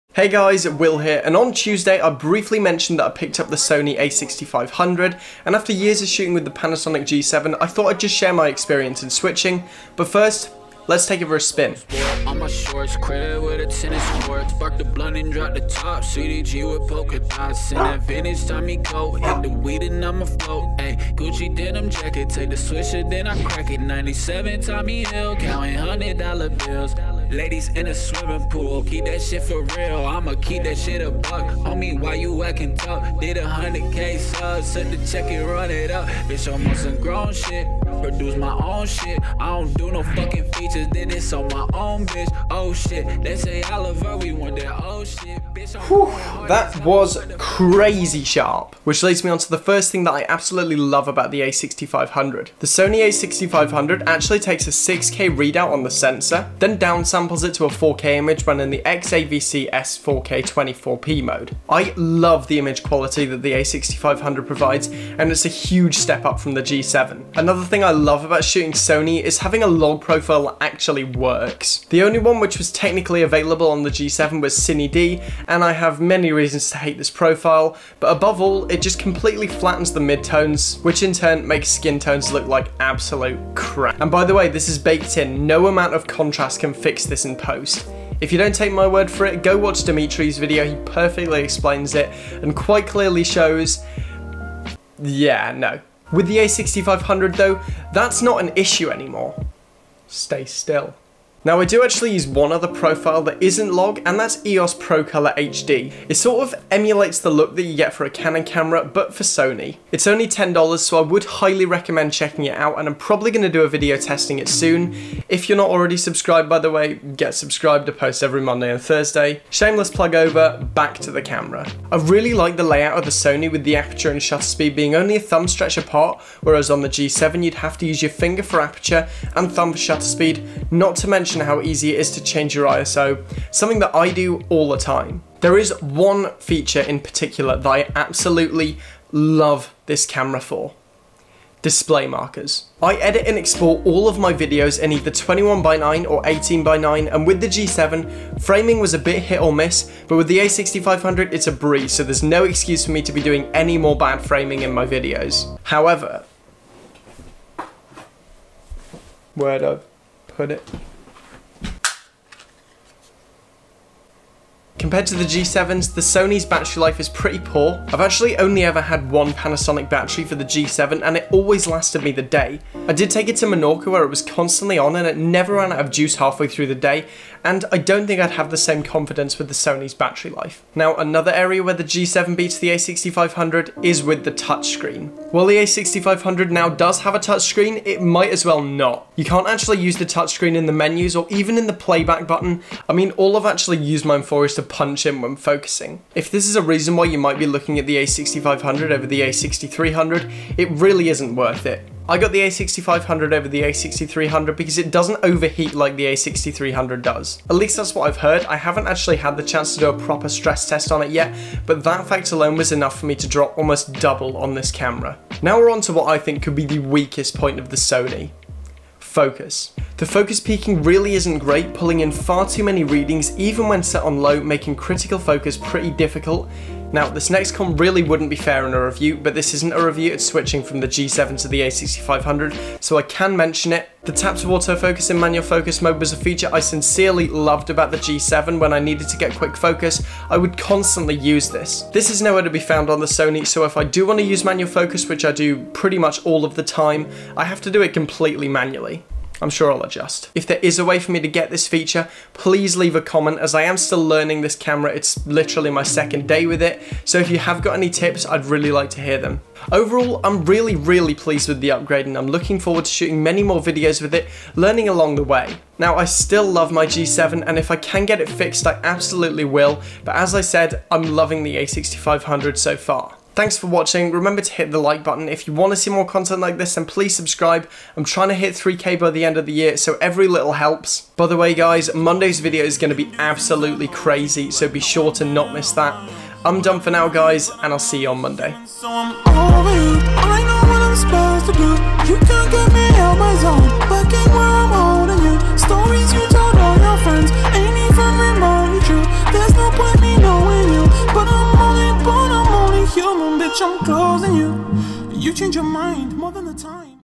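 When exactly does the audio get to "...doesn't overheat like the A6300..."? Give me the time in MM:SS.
03:24.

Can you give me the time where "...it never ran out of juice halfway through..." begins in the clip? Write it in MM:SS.
02:55.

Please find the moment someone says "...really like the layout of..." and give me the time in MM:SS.
02:01.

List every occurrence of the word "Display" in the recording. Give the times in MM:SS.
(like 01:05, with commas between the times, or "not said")
02:21.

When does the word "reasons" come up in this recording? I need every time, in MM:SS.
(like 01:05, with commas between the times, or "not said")
01:16, 03:16.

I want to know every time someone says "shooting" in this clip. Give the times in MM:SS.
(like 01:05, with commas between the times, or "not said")
00:06, 01:08, 04:22.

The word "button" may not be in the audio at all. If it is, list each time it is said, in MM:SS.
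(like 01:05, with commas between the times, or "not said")
03:12, 04:35.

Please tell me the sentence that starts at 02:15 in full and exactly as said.
There is one feature in particular that I absolutely love this camera for.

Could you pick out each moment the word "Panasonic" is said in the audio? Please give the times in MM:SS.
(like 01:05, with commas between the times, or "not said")
00:06, 02:49.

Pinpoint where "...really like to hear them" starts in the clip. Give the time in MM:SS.
04:18.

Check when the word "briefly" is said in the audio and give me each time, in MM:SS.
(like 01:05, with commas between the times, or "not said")
00:02.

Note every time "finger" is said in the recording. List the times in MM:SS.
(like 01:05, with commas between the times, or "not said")
02:08.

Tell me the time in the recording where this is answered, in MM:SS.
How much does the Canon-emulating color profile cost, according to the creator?
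01:50.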